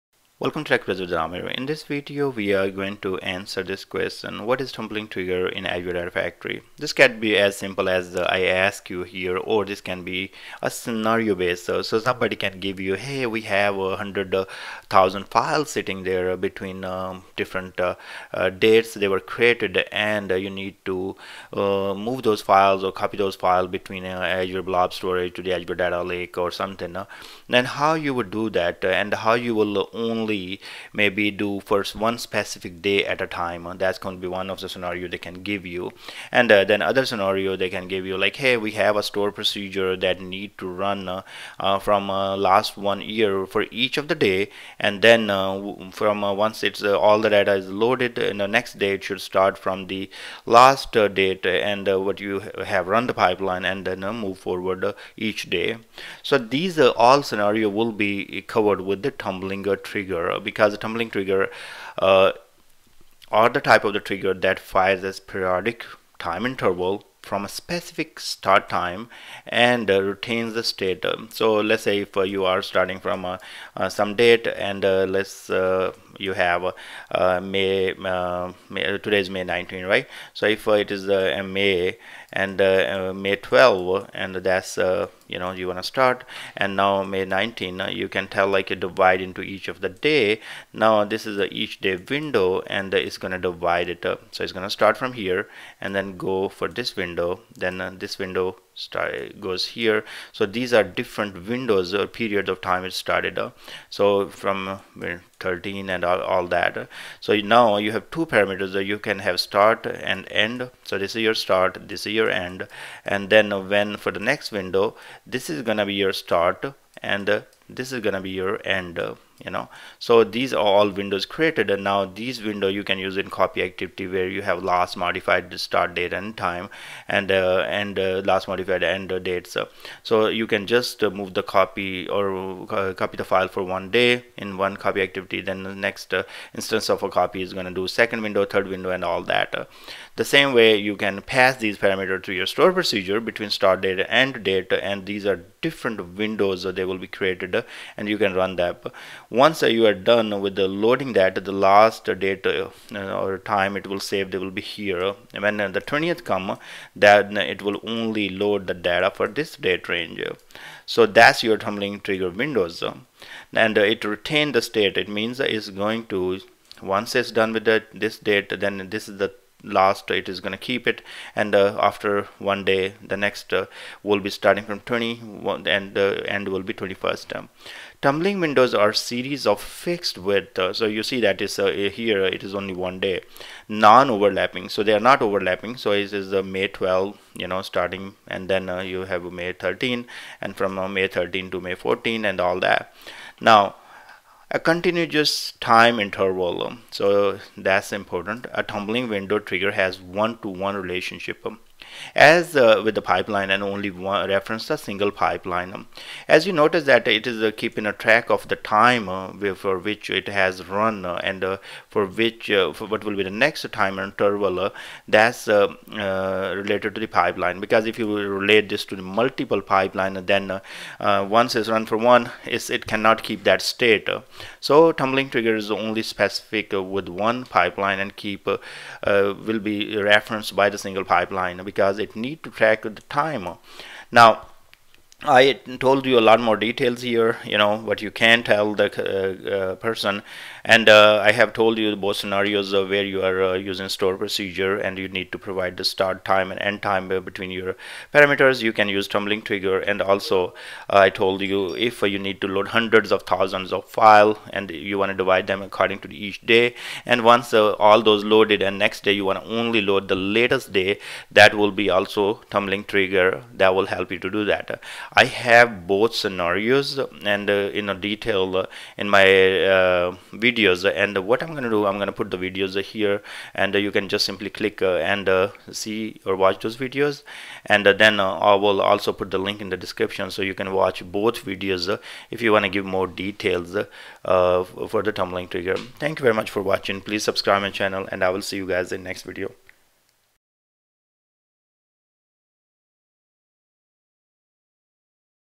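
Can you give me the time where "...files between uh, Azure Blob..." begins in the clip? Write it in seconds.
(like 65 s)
23 s.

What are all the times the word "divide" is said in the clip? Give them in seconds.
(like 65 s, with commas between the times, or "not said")
88 s, 93 s, 255 s.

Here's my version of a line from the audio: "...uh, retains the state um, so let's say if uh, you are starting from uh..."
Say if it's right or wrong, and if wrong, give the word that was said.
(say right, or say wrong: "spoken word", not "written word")
right.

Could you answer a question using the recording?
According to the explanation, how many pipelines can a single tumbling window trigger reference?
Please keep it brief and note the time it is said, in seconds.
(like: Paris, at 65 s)
1, at 200 s.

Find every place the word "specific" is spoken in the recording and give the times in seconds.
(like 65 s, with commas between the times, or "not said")
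32 s, 67 s, 226 s.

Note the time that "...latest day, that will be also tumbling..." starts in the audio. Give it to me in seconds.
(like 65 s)
260 s.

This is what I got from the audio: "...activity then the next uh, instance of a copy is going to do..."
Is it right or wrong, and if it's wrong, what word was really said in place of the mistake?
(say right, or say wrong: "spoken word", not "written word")
right.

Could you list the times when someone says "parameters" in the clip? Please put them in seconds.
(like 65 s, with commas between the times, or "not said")
108 s, 141 s, 248 s.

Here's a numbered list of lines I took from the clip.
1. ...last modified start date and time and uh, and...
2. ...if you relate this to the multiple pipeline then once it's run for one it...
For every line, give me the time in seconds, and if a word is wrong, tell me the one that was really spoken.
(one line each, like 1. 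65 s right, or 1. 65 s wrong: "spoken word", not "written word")
1. 124 s right
2. 217 s right.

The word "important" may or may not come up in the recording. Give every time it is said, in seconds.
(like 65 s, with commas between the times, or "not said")
197 s.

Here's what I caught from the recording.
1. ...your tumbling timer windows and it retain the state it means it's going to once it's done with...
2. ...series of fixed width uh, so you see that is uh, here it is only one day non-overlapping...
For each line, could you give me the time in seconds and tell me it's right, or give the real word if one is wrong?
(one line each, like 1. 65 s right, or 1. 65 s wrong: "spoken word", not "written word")
1. 161 s wrong: "trigger", not "timer"
2. 178 s right.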